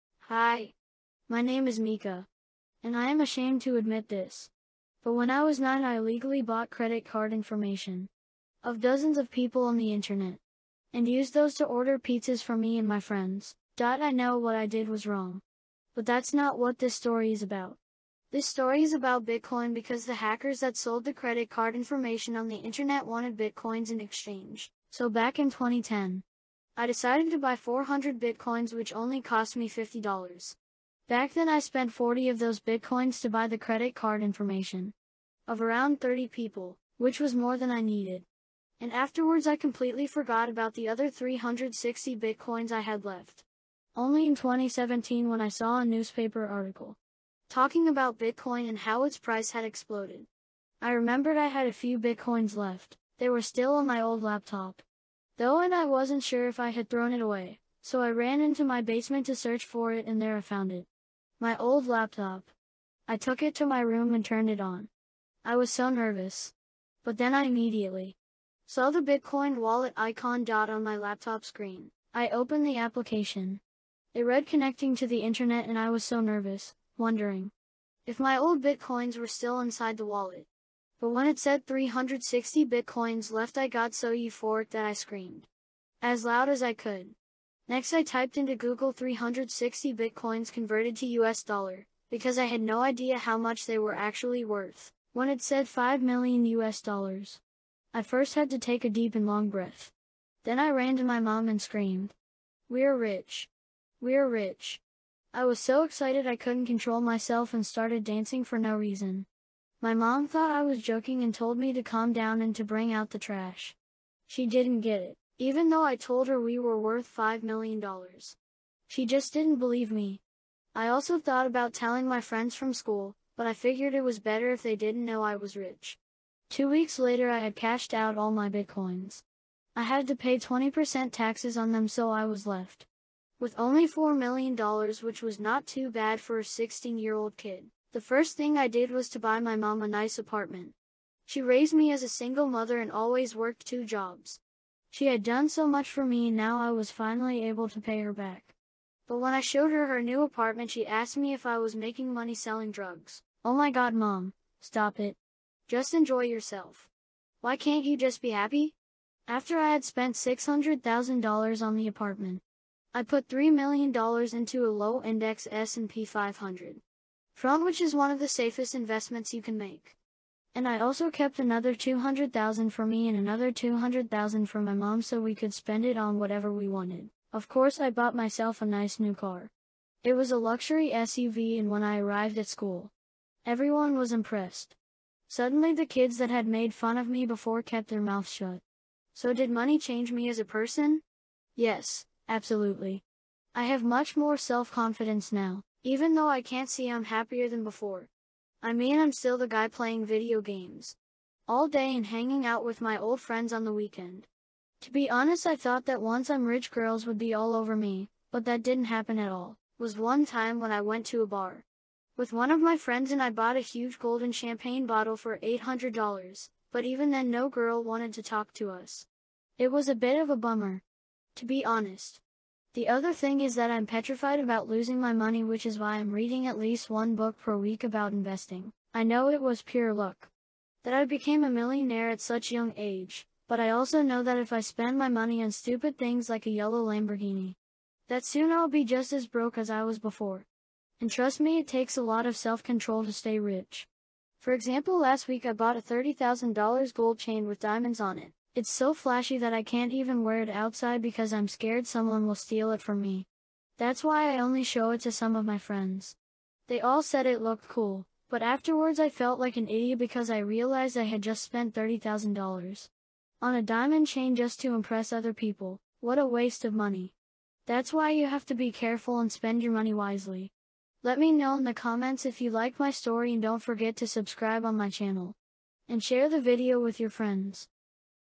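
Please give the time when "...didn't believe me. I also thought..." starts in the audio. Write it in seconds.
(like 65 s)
119 s.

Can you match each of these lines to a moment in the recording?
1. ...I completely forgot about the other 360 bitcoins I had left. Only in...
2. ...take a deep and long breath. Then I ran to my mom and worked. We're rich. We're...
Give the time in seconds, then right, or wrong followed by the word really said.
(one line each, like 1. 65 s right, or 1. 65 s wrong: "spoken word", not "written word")
1. 39 s right
2. 98 s wrong: "screamed", not "worked".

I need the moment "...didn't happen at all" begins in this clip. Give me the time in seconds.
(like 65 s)
208 s.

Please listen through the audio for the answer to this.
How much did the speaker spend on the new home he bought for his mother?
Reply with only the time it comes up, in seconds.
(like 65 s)
160 s.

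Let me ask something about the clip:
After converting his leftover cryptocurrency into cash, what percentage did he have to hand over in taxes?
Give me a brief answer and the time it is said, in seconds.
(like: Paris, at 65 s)
20%, at 130 s.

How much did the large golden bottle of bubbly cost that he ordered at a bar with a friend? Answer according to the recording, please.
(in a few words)
$800.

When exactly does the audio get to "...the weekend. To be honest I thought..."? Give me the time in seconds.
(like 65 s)
203 s.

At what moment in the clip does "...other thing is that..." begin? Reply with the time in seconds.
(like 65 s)
222 s.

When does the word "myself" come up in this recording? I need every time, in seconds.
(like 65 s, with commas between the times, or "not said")
107 s, 178 s.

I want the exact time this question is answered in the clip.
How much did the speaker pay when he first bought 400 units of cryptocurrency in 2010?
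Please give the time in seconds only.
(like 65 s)
29 s.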